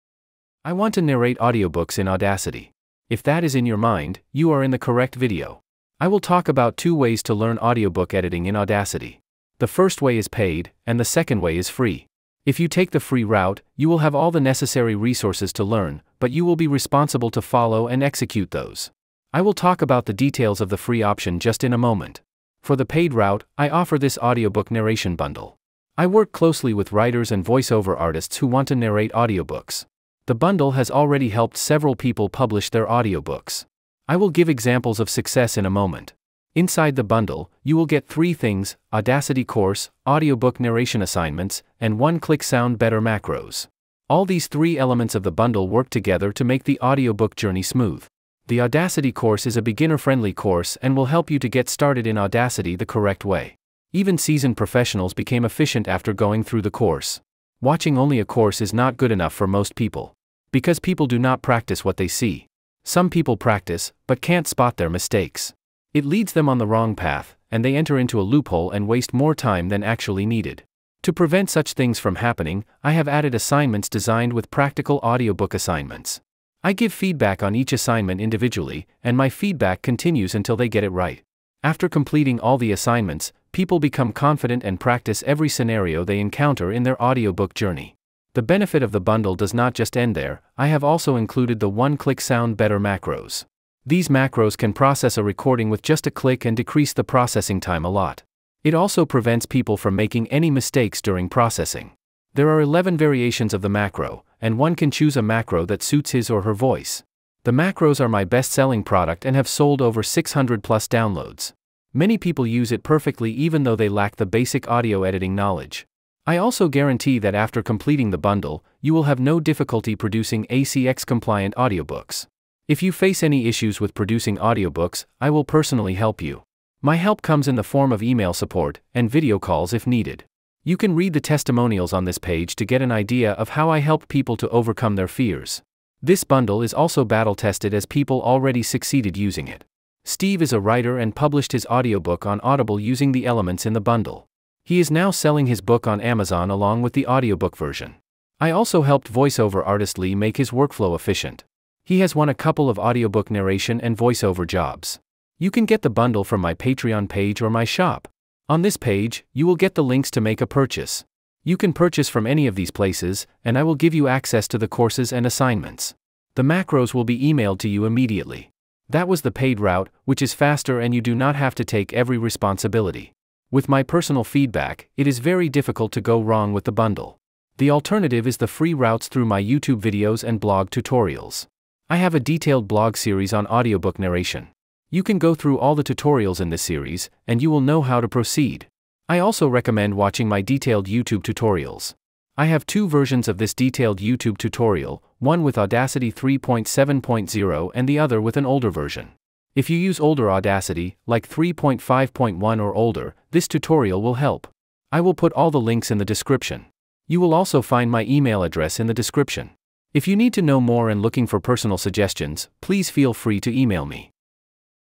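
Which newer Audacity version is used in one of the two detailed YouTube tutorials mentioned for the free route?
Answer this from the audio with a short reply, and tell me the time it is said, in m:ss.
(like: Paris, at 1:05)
3.7.0, at 3:16.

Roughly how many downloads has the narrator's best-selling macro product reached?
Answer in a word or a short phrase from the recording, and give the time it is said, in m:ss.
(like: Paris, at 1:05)
600 plus, at 1:50.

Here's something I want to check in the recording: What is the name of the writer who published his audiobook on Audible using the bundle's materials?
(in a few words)
Steve.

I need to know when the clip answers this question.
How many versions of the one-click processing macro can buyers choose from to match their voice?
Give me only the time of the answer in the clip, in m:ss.
1:42.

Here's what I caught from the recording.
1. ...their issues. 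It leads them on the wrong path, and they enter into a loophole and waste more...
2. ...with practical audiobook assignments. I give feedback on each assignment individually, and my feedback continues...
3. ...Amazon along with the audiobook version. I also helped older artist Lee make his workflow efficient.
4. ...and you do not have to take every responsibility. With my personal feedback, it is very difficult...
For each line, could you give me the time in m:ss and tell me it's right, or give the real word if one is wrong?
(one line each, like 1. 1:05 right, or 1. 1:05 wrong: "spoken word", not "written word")
1. 1:04 wrong: "mistakes", not "issues"
2. 1:14 right
3. 2:26 wrong: "voiceover", not "older"
4. 2:50 right.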